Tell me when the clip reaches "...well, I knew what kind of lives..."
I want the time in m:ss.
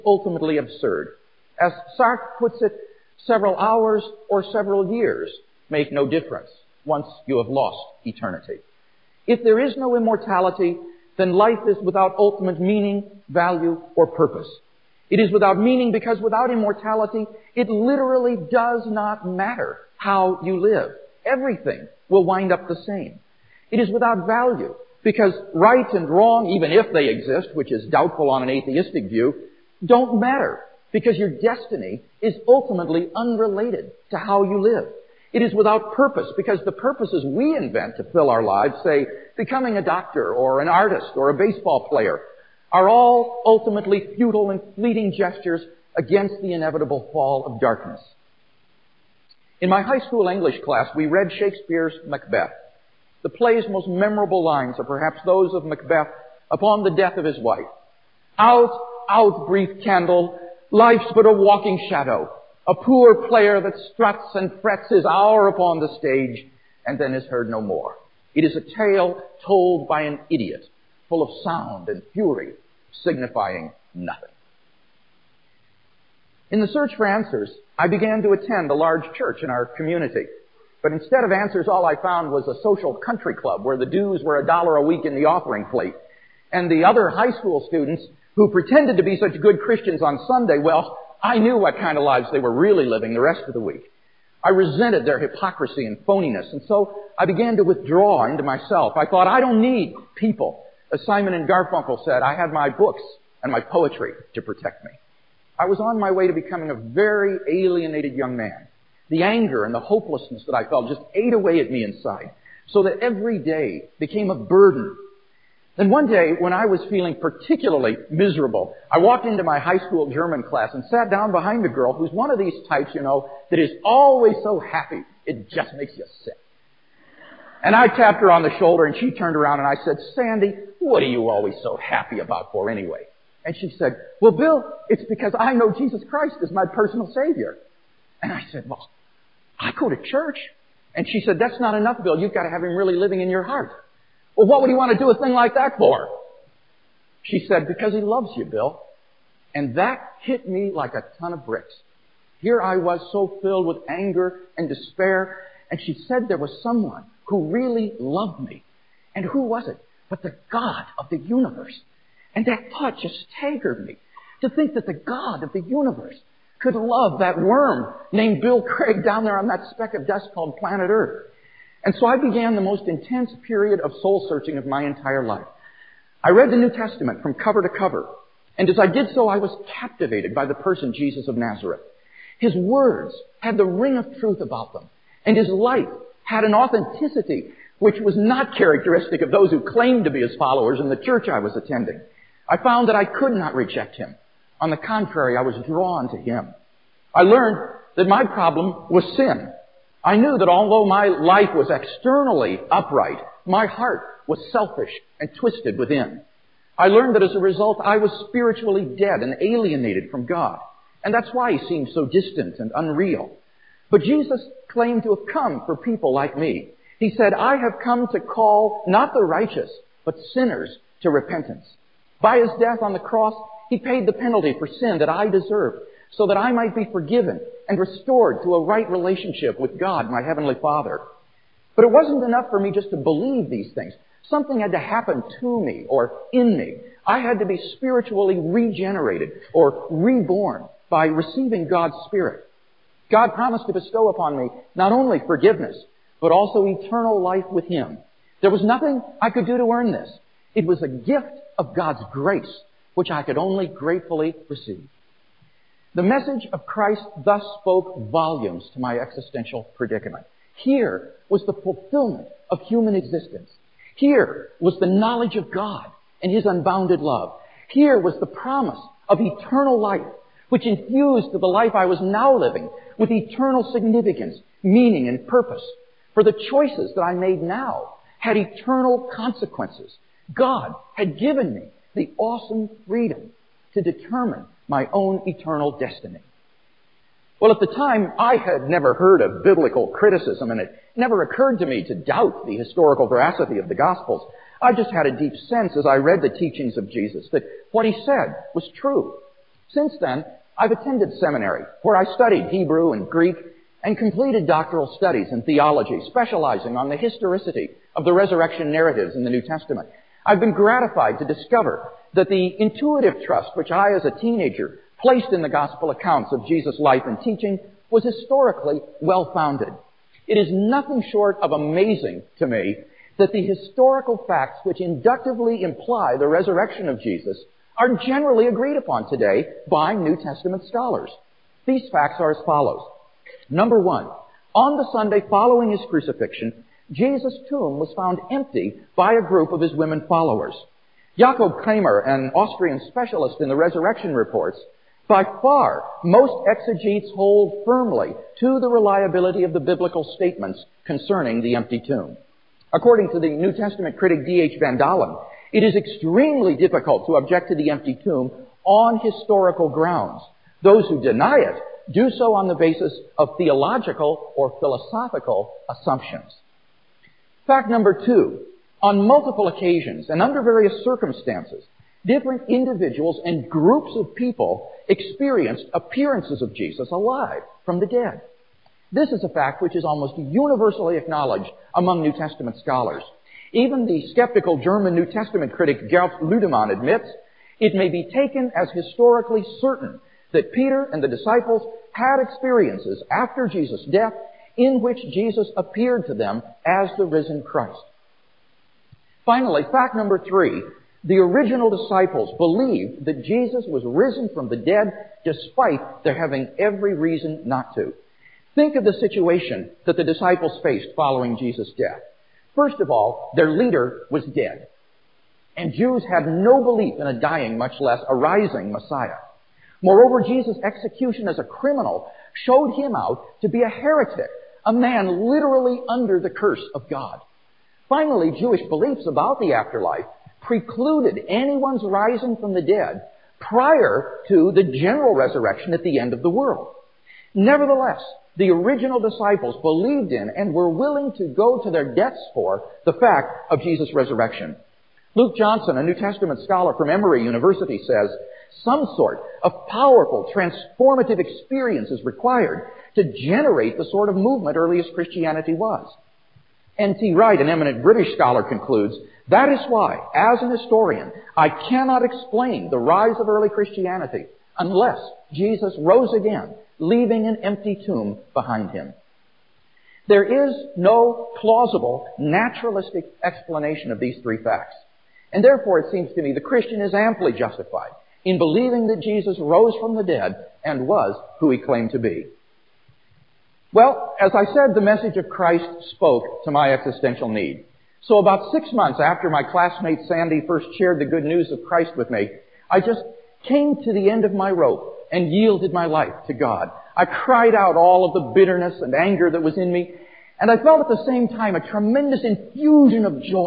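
1:30.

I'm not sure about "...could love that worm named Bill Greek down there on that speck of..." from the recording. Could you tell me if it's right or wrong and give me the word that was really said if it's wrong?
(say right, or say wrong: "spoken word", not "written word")
wrong: "Craig", not "Greek".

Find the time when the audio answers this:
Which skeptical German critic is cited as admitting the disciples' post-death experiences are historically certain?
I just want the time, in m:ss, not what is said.
6:25.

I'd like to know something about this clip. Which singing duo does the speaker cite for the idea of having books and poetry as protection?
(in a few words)
Simon and Garfunkel.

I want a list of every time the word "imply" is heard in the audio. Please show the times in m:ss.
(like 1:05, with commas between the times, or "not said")
5:25.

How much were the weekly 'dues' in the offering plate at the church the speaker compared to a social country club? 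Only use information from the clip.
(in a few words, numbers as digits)
$1 a week.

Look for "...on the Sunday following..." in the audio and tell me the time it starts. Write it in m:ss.
5:34.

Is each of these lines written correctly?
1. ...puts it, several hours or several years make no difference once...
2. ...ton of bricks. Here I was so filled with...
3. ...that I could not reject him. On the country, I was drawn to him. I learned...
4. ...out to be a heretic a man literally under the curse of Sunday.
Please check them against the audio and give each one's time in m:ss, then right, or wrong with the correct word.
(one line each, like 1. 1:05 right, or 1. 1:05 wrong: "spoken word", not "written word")
1. 0:02 right
2. 2:31 right
3. 3:12 wrong: "contrary", not "country"
4. 7:02 wrong: "God", not "Sunday".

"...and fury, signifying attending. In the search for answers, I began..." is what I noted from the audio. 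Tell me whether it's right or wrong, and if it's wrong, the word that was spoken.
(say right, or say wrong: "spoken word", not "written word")
wrong: "nothing", not "attending".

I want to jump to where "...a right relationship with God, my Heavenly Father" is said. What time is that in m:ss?
3:48.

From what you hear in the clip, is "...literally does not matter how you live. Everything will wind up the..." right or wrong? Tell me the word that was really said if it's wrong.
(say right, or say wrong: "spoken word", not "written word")
right.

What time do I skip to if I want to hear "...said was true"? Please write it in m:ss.
4:58.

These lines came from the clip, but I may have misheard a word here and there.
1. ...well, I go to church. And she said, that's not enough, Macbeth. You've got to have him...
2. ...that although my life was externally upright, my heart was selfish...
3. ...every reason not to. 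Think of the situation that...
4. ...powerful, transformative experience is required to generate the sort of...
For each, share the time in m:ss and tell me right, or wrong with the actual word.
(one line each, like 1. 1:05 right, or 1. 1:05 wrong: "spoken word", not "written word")
1. 2:18 wrong: "Bill", not "Macbeth"
2. 3:20 right
3. 6:46 right
4. 7:29 right.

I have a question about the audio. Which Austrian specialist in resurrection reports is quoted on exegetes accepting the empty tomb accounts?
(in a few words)
Jakob Kremer.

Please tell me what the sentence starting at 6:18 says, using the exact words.
This is a fact which is almost universally acknowledged among New Testament scholars.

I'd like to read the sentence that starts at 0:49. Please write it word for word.
In my high school English class, we read Shakespeare's Macbeth.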